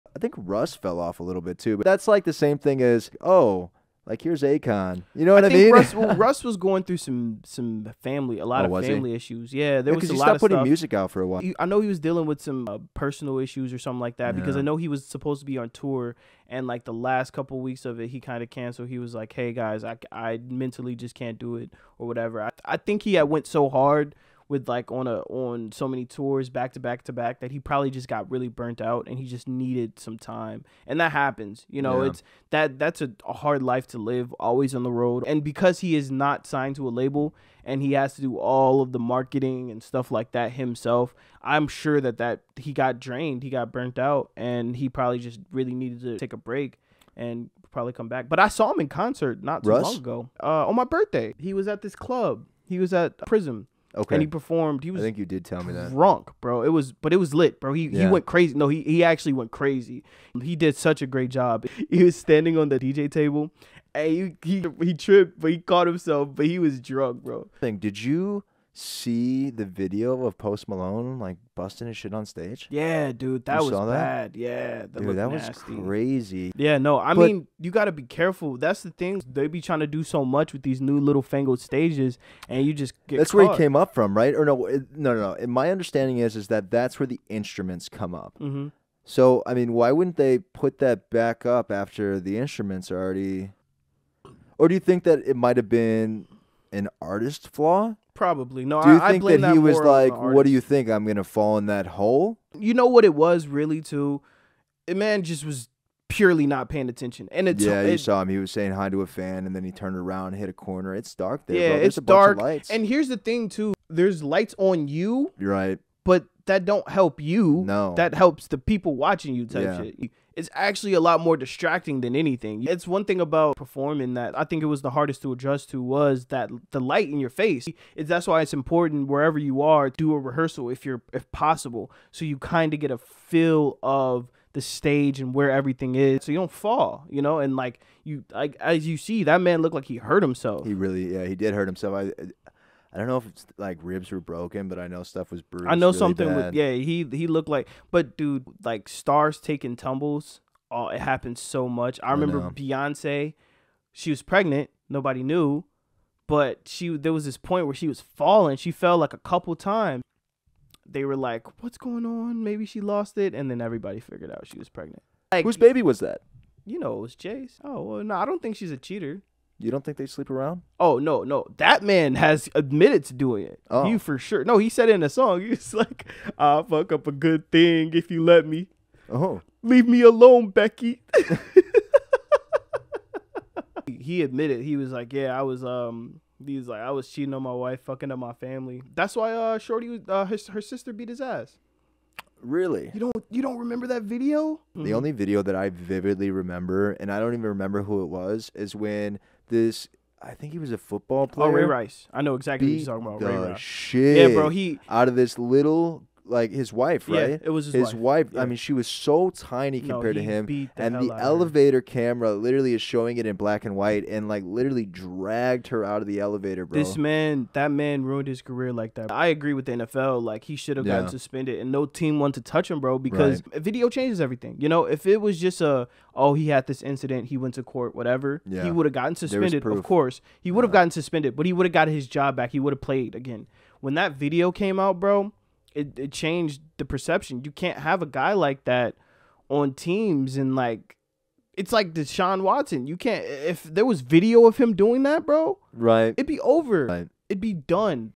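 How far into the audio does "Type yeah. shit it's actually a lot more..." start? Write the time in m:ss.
1:59.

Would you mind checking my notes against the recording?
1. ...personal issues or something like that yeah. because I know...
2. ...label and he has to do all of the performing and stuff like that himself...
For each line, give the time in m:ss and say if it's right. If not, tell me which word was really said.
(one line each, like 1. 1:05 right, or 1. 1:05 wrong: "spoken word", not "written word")
1. 0:12 right
2. 0:36 wrong: "marketing", not "performing".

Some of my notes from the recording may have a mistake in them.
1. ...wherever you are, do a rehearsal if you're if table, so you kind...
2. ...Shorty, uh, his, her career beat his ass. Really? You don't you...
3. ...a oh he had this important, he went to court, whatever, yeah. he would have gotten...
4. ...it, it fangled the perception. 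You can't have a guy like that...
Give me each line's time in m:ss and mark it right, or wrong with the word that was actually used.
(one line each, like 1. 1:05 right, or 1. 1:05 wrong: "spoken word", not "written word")
1. 2:09 wrong: "possible", not "table"
2. 3:09 wrong: "sister", not "career"
3. 3:45 wrong: "incident", not "important"
4. 3:55 wrong: "changed", not "fangled".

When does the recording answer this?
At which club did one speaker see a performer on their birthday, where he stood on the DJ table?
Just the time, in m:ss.
0:53.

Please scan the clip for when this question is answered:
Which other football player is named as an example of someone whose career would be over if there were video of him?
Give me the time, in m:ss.
4:01.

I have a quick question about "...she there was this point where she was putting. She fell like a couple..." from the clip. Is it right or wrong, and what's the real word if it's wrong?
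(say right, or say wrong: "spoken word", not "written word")
wrong: "falling", not "putting".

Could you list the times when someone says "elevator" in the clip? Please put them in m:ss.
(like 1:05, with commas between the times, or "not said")
3:31, 3:36.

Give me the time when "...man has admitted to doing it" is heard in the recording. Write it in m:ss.
2:51.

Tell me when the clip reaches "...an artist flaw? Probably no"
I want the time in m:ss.
1:36.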